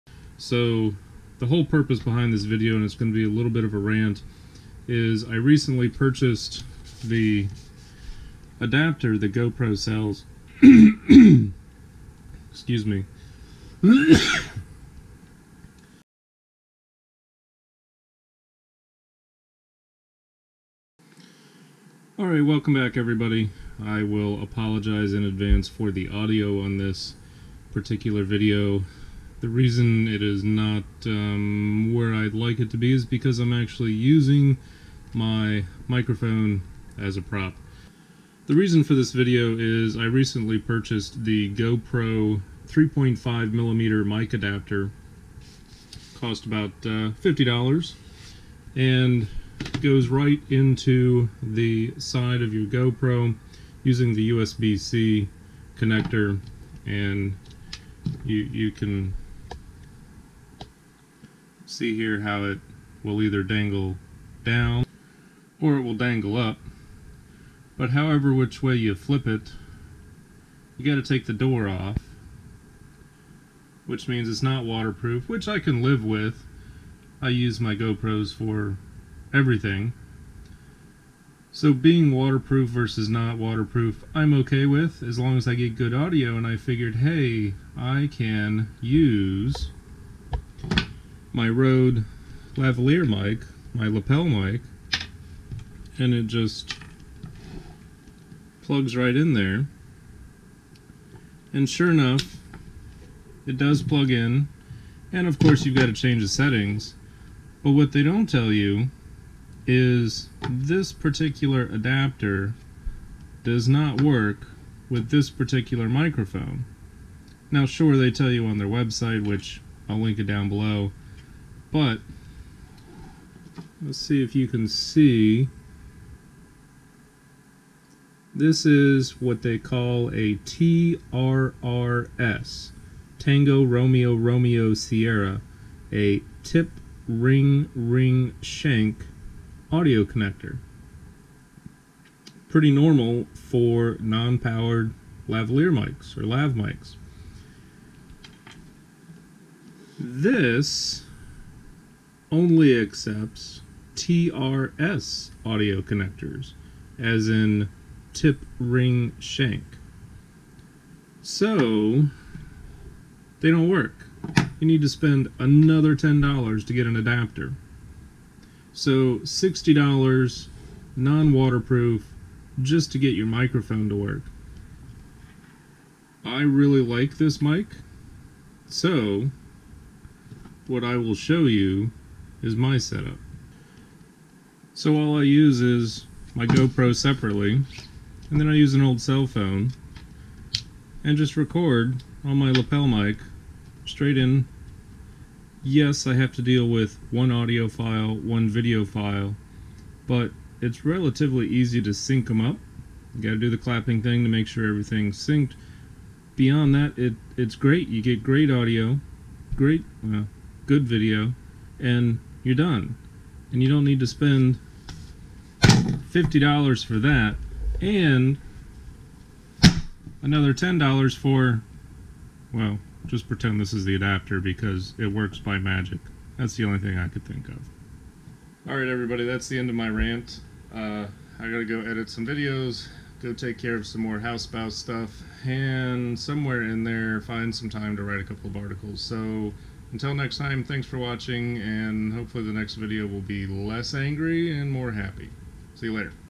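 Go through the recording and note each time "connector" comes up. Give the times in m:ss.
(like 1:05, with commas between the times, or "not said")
0:55, 2:20, 2:35.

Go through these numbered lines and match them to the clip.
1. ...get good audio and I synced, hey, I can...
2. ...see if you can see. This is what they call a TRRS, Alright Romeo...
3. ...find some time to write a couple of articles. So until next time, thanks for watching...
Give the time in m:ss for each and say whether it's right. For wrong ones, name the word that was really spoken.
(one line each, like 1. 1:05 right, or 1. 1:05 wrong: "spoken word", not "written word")
1. 1:25 wrong: "figured", not "synced"
2. 2:03 wrong: "Tango", not "Alright"
3. 3:57 right.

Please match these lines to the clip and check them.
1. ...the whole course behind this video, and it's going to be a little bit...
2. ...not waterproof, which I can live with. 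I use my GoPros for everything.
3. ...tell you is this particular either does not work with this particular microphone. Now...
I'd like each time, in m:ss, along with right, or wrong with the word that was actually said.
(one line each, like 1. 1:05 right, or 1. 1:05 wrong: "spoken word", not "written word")
1. 0:01 wrong: "purpose", not "course"
2. 1:14 right
3. 1:48 wrong: "adapter", not "either".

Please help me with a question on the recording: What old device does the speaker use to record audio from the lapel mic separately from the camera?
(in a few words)
cell phone.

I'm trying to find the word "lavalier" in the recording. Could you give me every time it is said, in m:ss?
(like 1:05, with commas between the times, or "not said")
1:32, 2:25.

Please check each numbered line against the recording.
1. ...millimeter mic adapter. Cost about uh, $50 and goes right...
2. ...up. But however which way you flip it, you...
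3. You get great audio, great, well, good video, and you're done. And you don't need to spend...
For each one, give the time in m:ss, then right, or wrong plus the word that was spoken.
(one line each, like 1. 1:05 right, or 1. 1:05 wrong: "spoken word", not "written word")
1. 0:43 right
2. 1:06 right
3. 3:27 right.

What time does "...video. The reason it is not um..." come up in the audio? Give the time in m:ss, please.
0:28.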